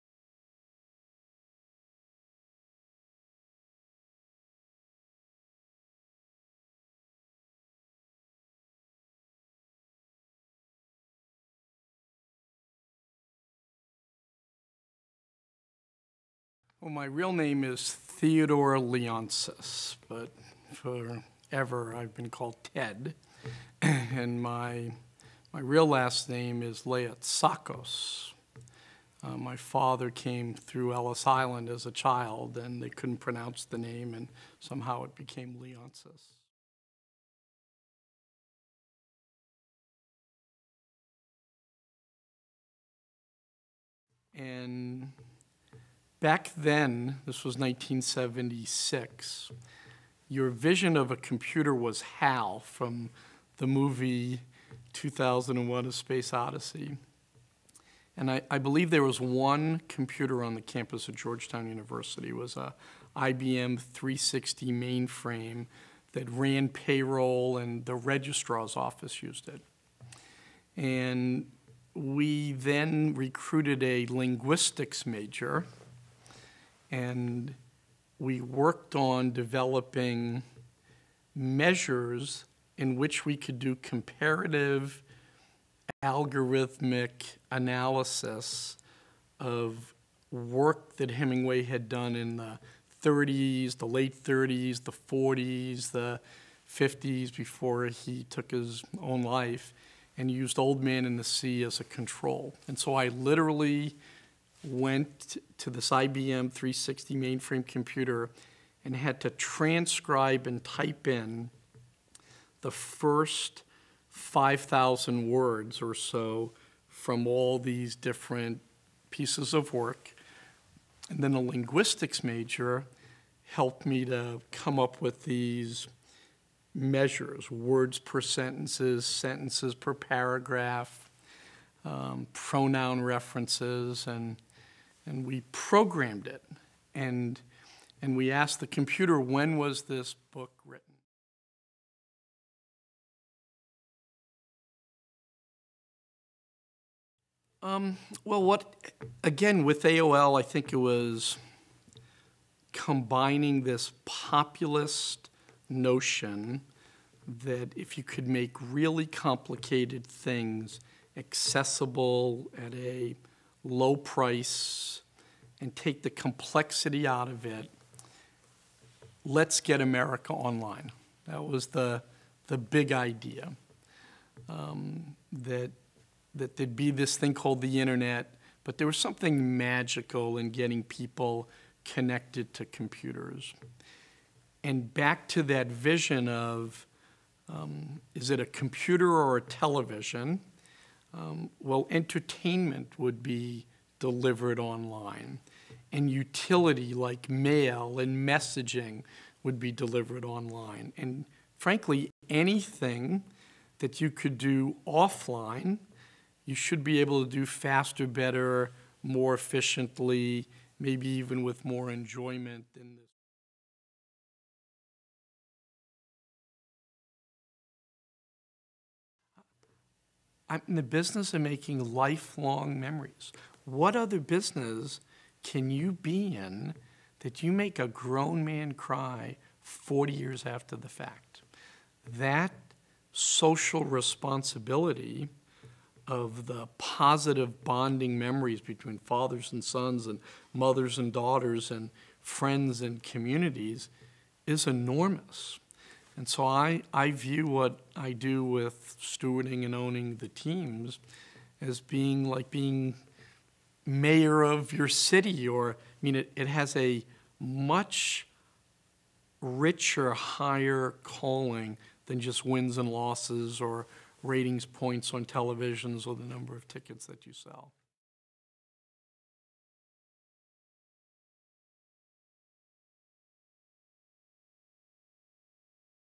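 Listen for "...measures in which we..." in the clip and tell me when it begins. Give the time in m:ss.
1:21.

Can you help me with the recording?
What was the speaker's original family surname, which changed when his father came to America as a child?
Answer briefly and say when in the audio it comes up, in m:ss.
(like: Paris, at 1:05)
Leotsakos, at 0:26.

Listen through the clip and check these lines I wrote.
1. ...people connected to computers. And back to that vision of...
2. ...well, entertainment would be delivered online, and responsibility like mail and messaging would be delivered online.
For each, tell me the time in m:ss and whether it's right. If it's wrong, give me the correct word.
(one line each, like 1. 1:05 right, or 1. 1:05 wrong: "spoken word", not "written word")
1. 3:00 right
2. 3:11 wrong: "utility", not "responsibility".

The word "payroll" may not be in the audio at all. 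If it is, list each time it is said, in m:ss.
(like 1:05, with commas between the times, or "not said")
1:06.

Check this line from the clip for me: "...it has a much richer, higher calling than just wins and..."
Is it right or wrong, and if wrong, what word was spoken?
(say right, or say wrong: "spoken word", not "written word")
right.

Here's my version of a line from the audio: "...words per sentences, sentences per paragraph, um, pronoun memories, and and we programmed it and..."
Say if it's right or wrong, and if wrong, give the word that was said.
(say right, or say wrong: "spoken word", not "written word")
wrong: "references", not "memories".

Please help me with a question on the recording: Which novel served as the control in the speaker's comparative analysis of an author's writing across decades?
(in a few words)
Old Man in the Sea.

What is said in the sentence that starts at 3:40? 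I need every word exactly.
I'm in the business of making lifelong memories.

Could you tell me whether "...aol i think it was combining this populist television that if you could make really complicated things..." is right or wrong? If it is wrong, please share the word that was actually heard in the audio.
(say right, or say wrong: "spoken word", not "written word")
wrong: "notion", not "television".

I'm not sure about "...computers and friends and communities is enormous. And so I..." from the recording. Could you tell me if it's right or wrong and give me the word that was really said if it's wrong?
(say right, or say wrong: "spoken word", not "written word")
wrong: "daughters", not "computers".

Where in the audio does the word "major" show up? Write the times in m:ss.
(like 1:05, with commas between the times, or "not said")
1:15, 2:02.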